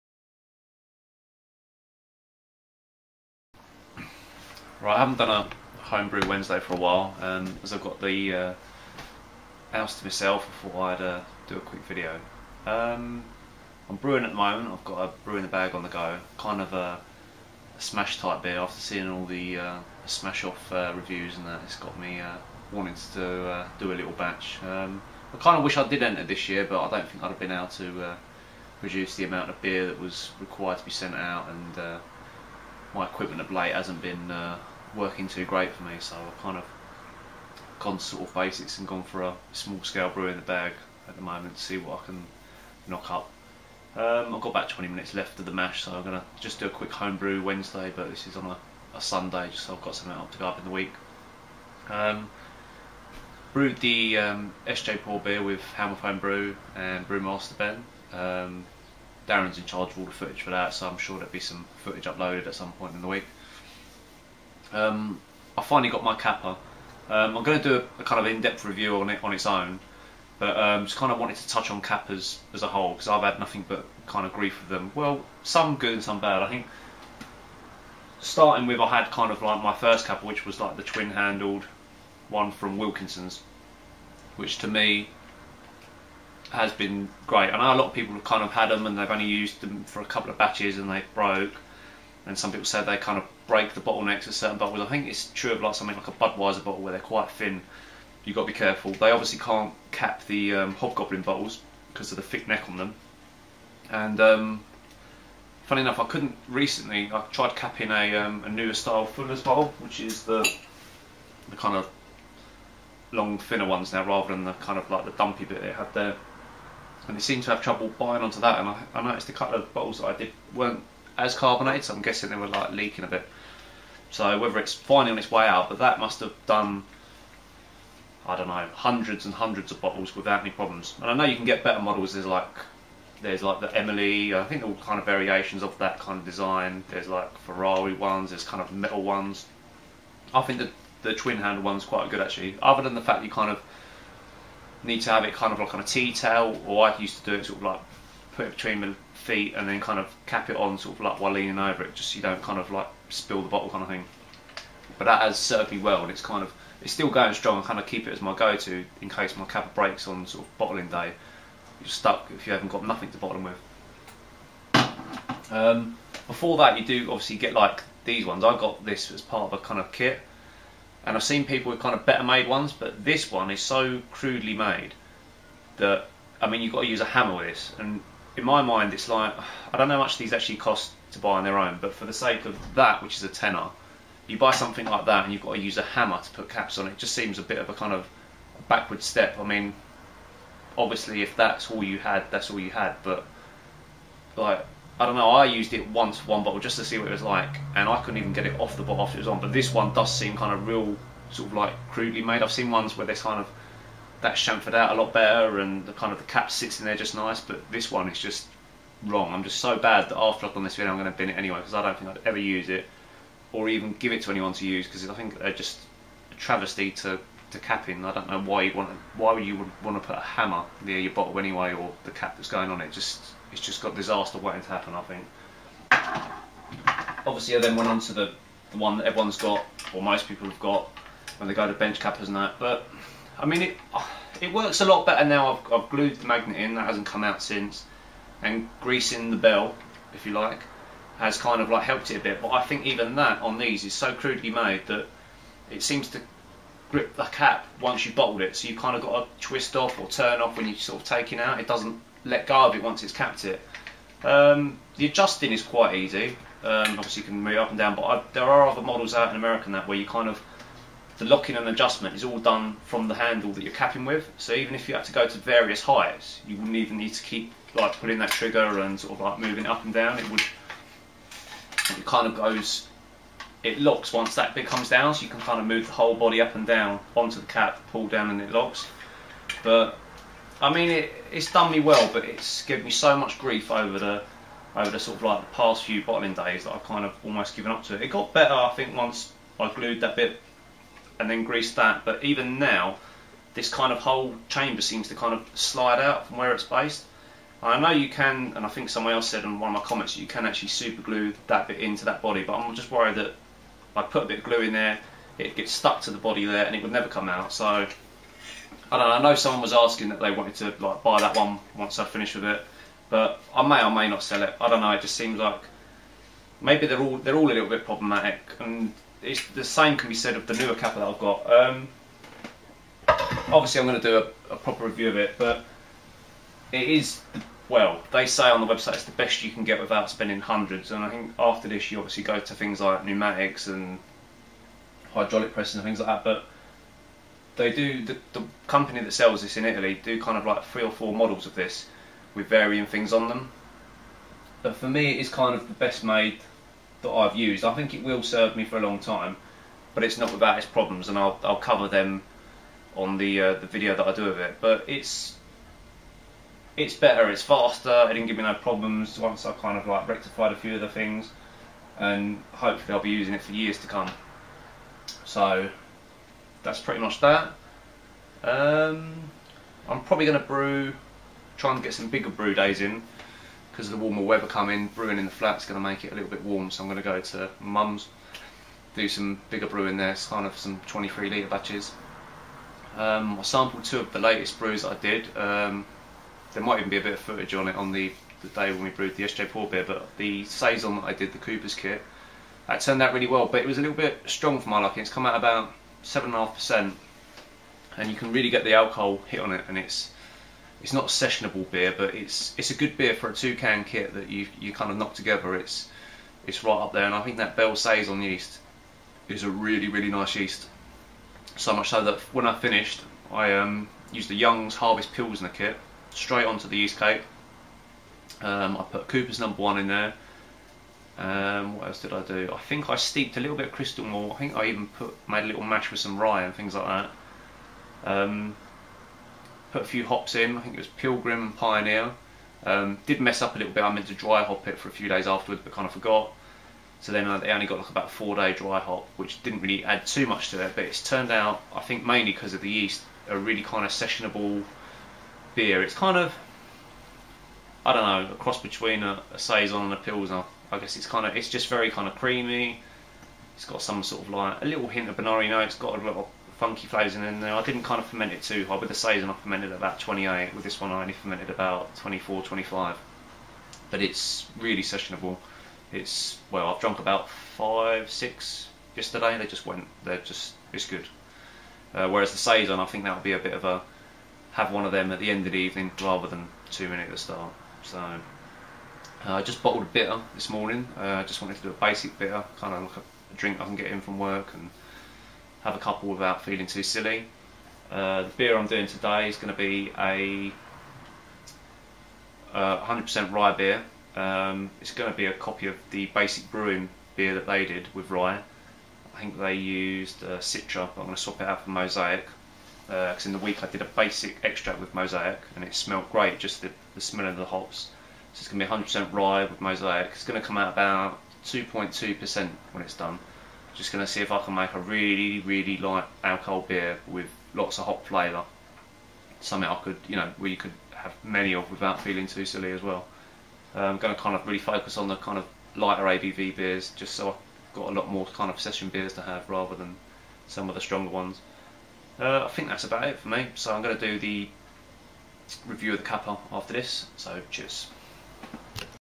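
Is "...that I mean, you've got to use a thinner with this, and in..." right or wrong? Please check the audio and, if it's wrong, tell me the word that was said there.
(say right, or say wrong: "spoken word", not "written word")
wrong: "hammer", not "thinner".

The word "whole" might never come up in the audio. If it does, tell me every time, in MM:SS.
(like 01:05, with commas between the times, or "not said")
01:12, 04:35, 04:53.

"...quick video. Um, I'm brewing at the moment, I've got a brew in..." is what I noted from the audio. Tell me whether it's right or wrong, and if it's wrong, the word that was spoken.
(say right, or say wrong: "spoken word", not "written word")
right.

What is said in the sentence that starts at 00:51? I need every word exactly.
Um, brewed the um, SJ Pour beer with Hammerphone Brew and Brewmaster Ben.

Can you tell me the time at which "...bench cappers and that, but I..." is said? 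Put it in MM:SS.
03:51.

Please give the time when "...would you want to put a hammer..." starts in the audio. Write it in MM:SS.
03:39.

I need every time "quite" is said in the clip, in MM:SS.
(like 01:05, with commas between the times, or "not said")
01:37, 02:21, 04:15.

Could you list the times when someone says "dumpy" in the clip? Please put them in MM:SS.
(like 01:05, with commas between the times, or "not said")
01:55.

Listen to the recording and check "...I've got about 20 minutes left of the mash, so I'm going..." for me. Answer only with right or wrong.
right.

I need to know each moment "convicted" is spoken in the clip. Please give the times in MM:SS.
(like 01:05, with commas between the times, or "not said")
not said.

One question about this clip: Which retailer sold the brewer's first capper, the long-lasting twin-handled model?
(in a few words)
Wilkinson's.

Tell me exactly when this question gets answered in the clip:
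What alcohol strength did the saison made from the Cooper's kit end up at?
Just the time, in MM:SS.
06:36.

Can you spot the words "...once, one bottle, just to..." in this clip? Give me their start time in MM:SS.
03:15.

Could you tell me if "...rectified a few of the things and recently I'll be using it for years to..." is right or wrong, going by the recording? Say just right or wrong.
wrong.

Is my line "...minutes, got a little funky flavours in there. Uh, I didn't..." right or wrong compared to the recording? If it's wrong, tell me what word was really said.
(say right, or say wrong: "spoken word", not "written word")
wrong: "notes", not "minutes".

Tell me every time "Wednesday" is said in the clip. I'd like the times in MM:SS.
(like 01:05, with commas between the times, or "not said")
00:06, 00:47.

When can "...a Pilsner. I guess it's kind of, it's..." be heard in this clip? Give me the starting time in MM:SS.
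07:29.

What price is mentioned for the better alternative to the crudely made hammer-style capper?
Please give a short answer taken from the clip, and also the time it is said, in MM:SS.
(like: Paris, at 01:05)
a tenner, at 03:03.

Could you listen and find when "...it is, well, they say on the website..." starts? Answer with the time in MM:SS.
05:26.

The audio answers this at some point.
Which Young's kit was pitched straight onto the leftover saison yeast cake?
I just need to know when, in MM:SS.
06:54.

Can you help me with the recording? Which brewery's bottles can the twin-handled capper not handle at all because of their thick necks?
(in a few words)
Hobgoblin.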